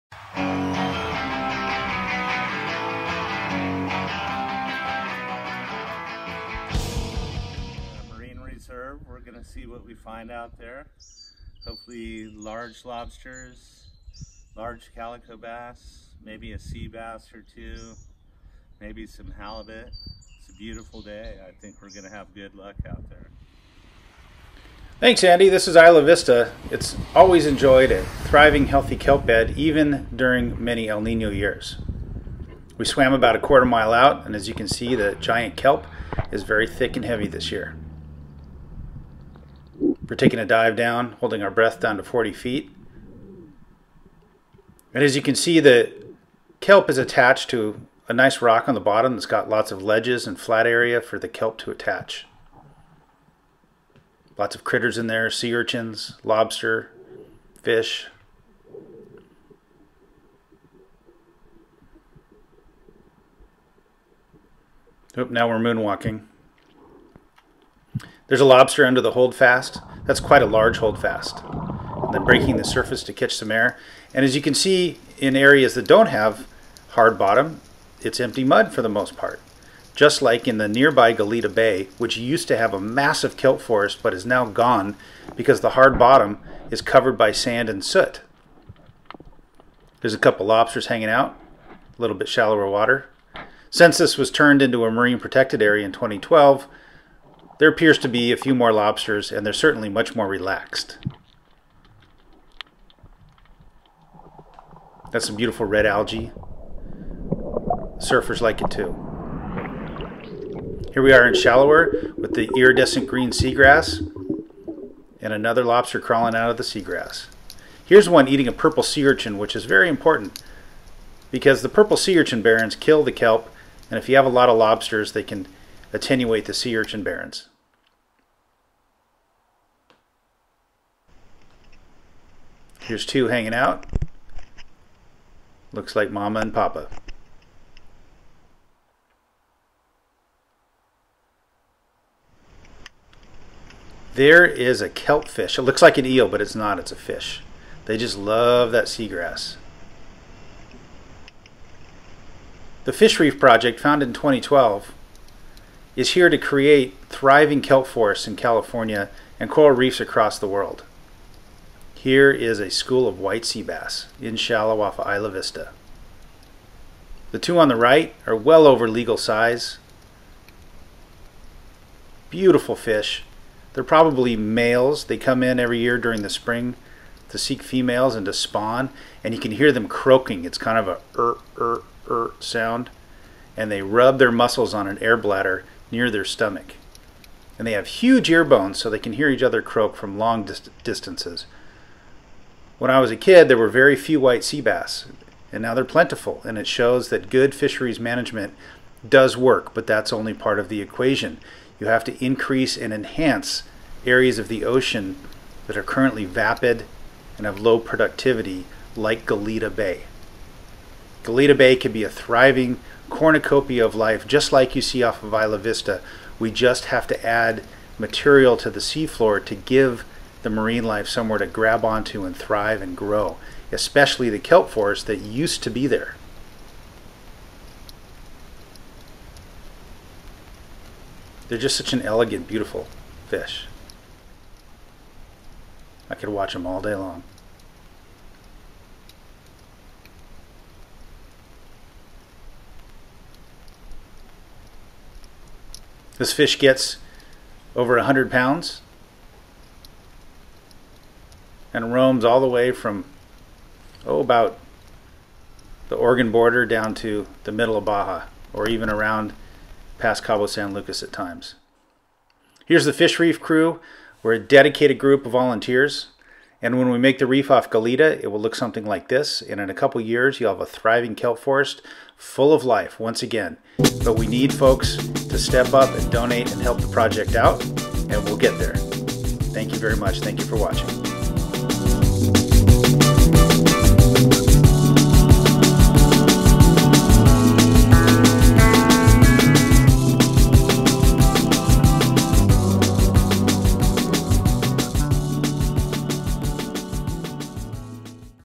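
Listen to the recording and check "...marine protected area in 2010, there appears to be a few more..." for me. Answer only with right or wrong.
wrong.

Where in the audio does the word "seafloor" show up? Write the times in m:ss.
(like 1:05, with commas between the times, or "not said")
3:38.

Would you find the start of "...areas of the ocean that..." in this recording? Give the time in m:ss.
3:24.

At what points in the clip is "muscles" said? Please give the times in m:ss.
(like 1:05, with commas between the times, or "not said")
3:04.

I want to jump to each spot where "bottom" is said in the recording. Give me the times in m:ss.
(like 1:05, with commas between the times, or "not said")
0:48, 1:17, 1:25.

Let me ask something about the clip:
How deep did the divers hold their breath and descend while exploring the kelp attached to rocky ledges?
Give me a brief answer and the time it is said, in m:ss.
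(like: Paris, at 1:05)
40 feet, at 0:42.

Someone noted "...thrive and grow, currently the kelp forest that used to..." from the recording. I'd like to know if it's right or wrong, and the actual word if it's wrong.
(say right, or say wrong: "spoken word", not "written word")
wrong: "especially", not "currently".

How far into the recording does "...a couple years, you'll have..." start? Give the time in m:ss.
4:29.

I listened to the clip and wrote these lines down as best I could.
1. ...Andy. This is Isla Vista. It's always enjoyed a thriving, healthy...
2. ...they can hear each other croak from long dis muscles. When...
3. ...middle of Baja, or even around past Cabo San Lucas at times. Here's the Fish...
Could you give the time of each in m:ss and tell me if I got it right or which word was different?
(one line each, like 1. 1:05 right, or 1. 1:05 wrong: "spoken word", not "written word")
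1. 0:25 right
2. 3:08 wrong: "distances", not "muscles"
3. 4:17 right.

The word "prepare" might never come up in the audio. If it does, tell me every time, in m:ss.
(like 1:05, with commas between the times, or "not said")
not said.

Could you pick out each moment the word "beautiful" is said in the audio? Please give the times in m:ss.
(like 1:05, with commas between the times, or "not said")
0:20, 1:45, 2:52, 3:52.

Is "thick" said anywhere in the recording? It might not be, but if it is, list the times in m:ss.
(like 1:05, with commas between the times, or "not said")
0:36.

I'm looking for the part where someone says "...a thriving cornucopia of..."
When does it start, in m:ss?
3:32.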